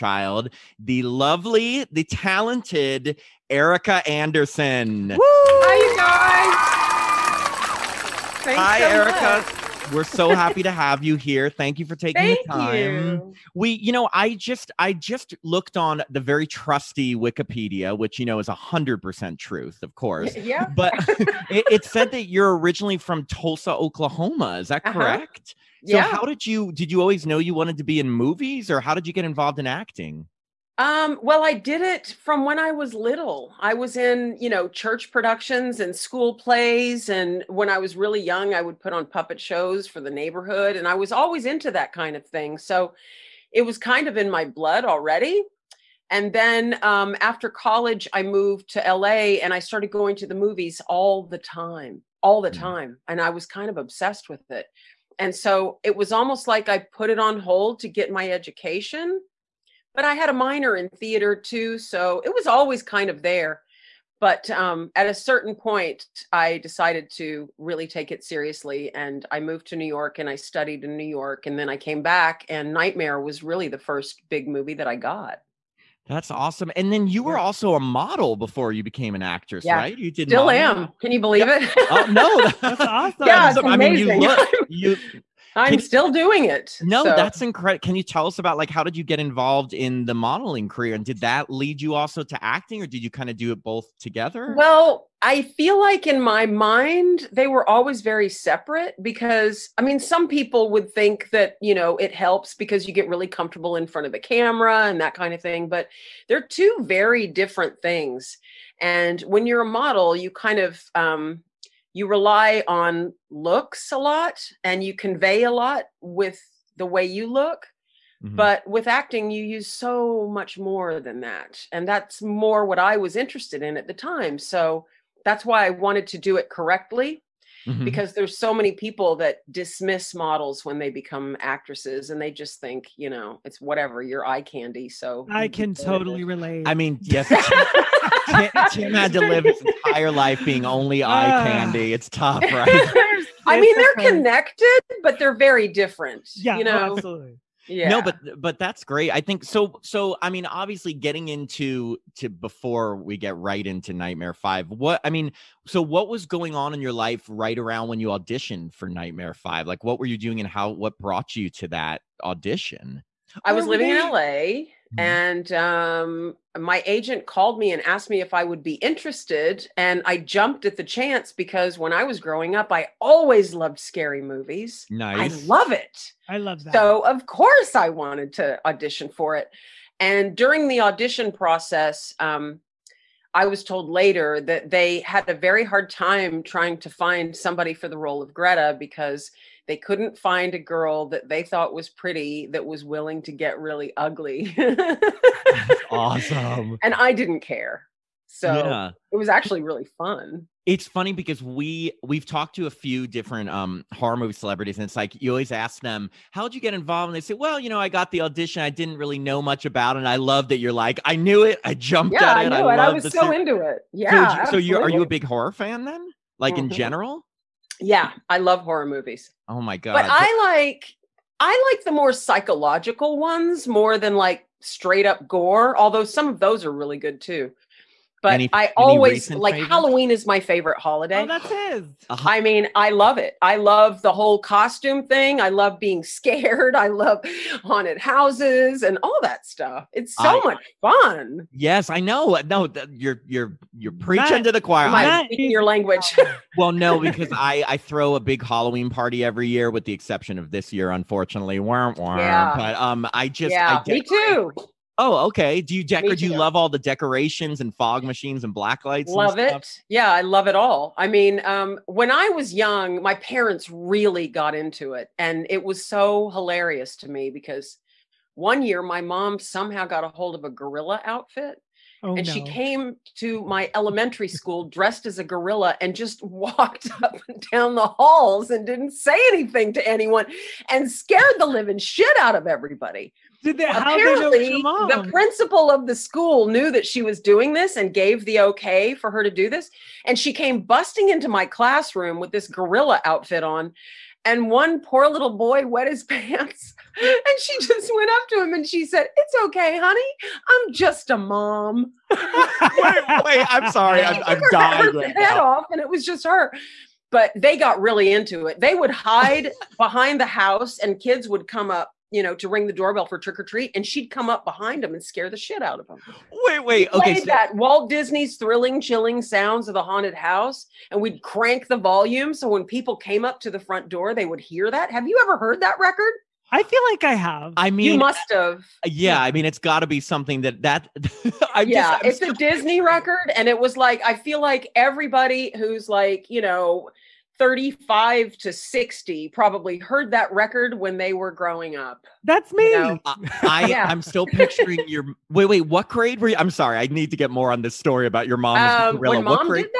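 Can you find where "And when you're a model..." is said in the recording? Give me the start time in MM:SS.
01:48.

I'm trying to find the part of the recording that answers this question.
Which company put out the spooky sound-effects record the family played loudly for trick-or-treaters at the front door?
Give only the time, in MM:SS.
05:17.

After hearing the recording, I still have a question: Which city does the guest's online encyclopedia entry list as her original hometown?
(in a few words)
Tulsa, Oklahoma.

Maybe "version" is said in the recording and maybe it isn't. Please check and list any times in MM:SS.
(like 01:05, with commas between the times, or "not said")
not said.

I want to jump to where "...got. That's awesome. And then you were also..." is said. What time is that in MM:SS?
01:14.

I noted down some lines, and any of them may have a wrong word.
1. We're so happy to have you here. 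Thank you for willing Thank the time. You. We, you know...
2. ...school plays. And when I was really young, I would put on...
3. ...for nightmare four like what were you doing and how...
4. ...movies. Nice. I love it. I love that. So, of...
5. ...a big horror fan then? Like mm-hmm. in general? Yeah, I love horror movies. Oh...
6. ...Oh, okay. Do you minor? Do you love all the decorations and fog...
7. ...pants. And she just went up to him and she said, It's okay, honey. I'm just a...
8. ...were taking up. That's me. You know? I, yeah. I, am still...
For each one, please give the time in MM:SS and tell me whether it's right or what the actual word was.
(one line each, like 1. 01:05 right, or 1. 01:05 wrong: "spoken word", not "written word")
1. 00:09 wrong: "taking", not "willing"
2. 00:35 right
3. 02:38 wrong: "five", not "four"
4. 02:54 right
5. 03:35 right
6. 04:14 wrong: "decor", not "minor"
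7. 04:56 right
8. 05:41 wrong: "growing", not "taking".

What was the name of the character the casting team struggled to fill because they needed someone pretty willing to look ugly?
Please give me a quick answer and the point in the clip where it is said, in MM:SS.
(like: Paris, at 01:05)
Greta, at 03:08.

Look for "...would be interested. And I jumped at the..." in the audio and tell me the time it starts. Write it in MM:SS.
02:48.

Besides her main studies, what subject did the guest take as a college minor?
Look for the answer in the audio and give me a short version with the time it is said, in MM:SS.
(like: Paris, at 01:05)
Theater, at 01:00.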